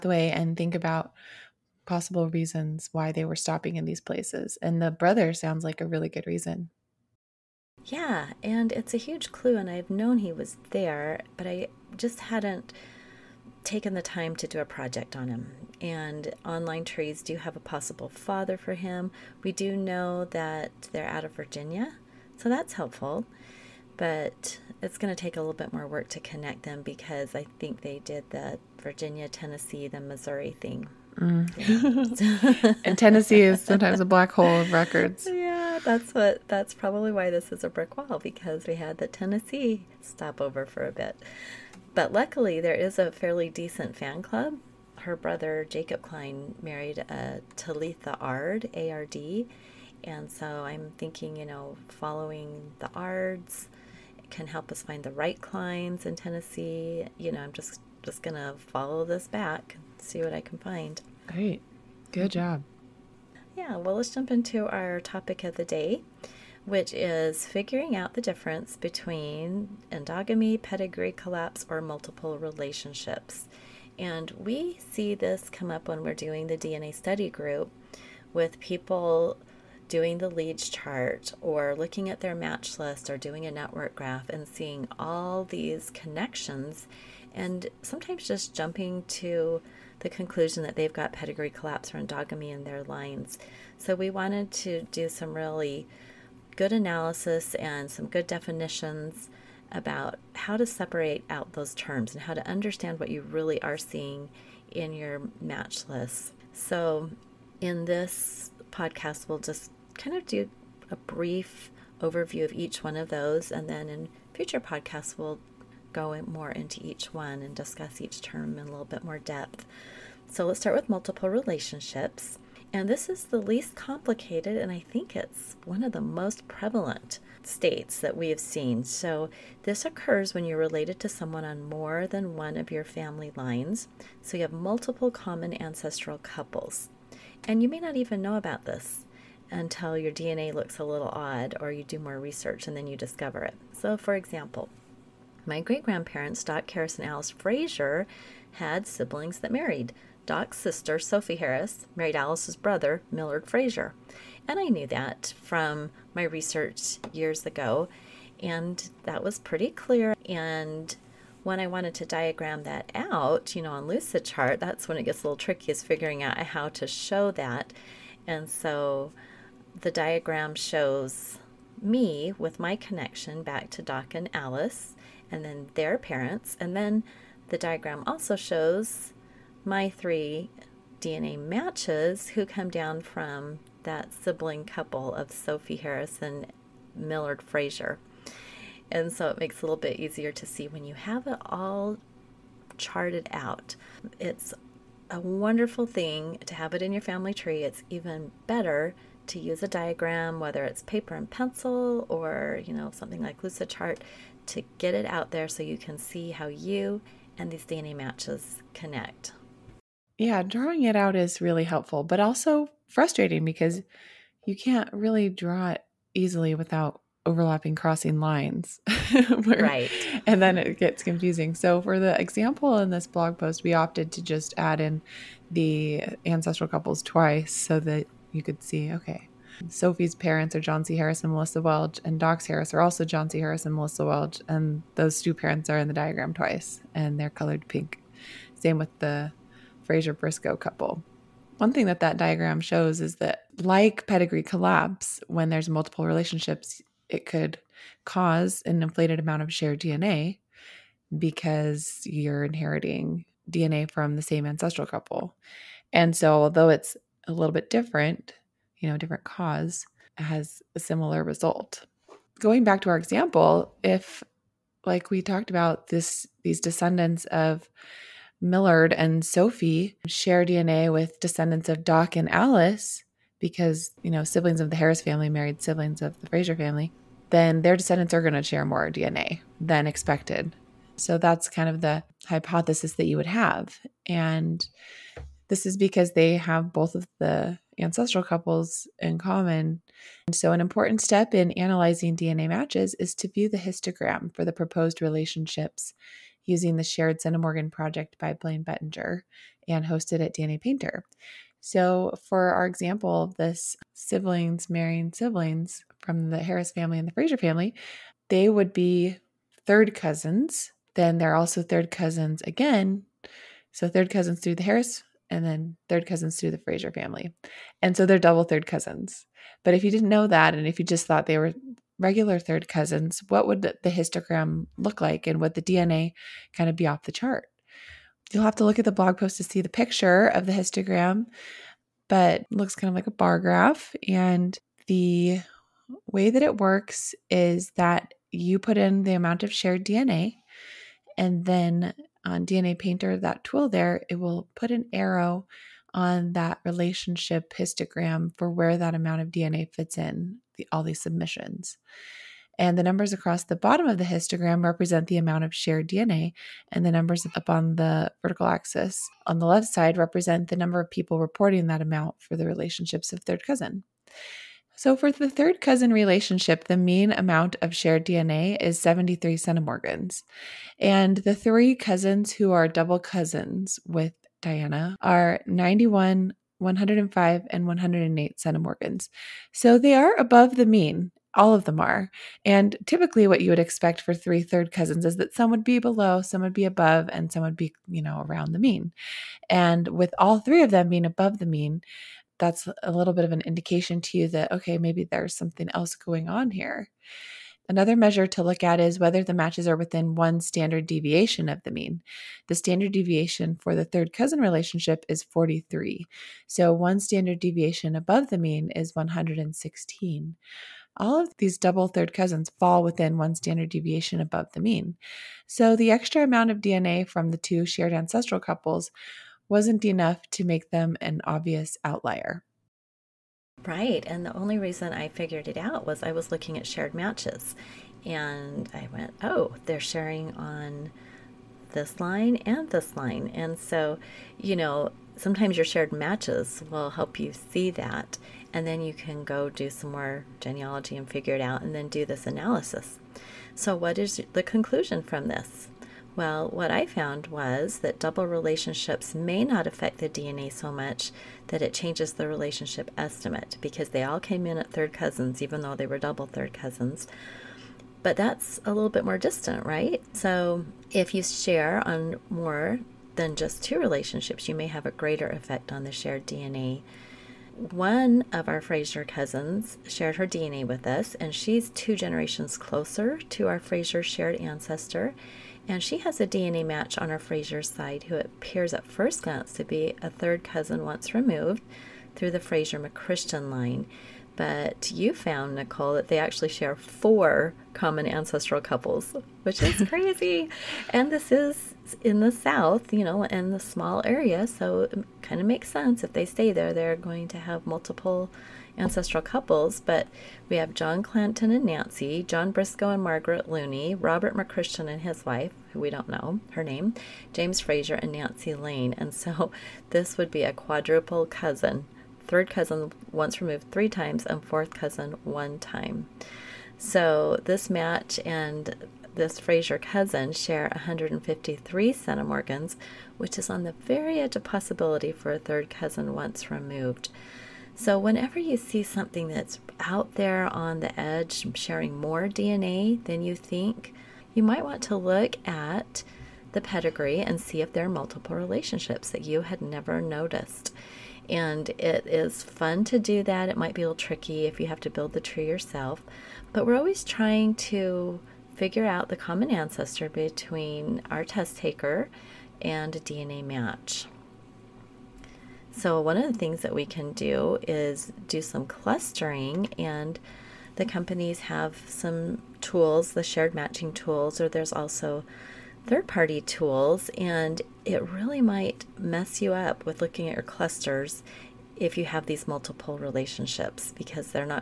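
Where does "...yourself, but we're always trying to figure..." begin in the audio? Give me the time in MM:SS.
09:05.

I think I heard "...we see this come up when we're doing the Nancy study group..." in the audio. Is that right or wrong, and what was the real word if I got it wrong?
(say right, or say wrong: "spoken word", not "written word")
wrong: "DNA", not "Nancy".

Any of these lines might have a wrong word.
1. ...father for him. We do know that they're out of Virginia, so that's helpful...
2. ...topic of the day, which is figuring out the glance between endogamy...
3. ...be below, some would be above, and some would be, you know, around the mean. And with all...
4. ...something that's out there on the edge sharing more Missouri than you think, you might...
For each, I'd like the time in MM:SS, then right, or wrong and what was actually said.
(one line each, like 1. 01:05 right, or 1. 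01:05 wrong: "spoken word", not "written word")
1. 00:18 right
2. 01:04 wrong: "difference", not "glance"
3. 06:25 right
4. 08:48 wrong: "DNA", not "Missouri".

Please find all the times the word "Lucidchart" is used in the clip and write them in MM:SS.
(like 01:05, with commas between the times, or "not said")
02:43, 03:23.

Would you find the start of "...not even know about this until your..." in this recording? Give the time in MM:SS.
02:17.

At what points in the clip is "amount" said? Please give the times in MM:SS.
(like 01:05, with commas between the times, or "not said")
04:09, 05:39, 05:48, 05:55, 06:01, 06:07, 06:56.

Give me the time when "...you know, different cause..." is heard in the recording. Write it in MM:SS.
04:18.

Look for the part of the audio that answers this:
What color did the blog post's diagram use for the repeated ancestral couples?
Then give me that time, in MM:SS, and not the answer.
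03:57.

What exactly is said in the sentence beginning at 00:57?
You know, I'm just just gonna follow this back, see what I can find.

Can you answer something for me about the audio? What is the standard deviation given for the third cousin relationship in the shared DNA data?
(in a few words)
43.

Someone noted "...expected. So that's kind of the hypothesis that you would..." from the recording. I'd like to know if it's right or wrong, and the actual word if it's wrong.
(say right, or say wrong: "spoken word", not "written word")
right.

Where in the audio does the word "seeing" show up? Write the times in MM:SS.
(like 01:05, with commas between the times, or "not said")
01:24, 01:43.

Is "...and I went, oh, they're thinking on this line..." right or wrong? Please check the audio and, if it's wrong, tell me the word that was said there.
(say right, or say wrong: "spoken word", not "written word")
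wrong: "sharing", not "thinking".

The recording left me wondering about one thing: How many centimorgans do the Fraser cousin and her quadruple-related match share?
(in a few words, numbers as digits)
153.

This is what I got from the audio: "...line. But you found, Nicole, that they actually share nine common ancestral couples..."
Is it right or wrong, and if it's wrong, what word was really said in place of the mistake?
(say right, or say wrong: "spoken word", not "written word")
wrong: "four", not "nine".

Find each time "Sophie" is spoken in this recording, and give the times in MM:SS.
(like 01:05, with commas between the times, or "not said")
02:30, 03:05, 03:49, 04:29.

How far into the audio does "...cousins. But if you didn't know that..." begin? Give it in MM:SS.
05:18.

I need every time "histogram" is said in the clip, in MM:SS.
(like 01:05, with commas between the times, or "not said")
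04:53, 05:23, 05:30, 05:47, 05:54.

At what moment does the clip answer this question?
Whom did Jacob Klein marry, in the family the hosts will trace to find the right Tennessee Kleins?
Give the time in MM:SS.
00:47.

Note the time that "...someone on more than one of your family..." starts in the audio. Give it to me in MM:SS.
02:11.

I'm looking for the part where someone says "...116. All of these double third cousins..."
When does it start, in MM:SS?
06:48.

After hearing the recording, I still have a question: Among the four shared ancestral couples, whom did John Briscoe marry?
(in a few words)
Margaret Looney.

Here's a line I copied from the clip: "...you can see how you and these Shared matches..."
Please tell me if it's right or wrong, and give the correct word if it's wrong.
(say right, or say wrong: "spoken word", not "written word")
wrong: "DNA", not "Shared".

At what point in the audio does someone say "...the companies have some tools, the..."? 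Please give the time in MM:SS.
09:20.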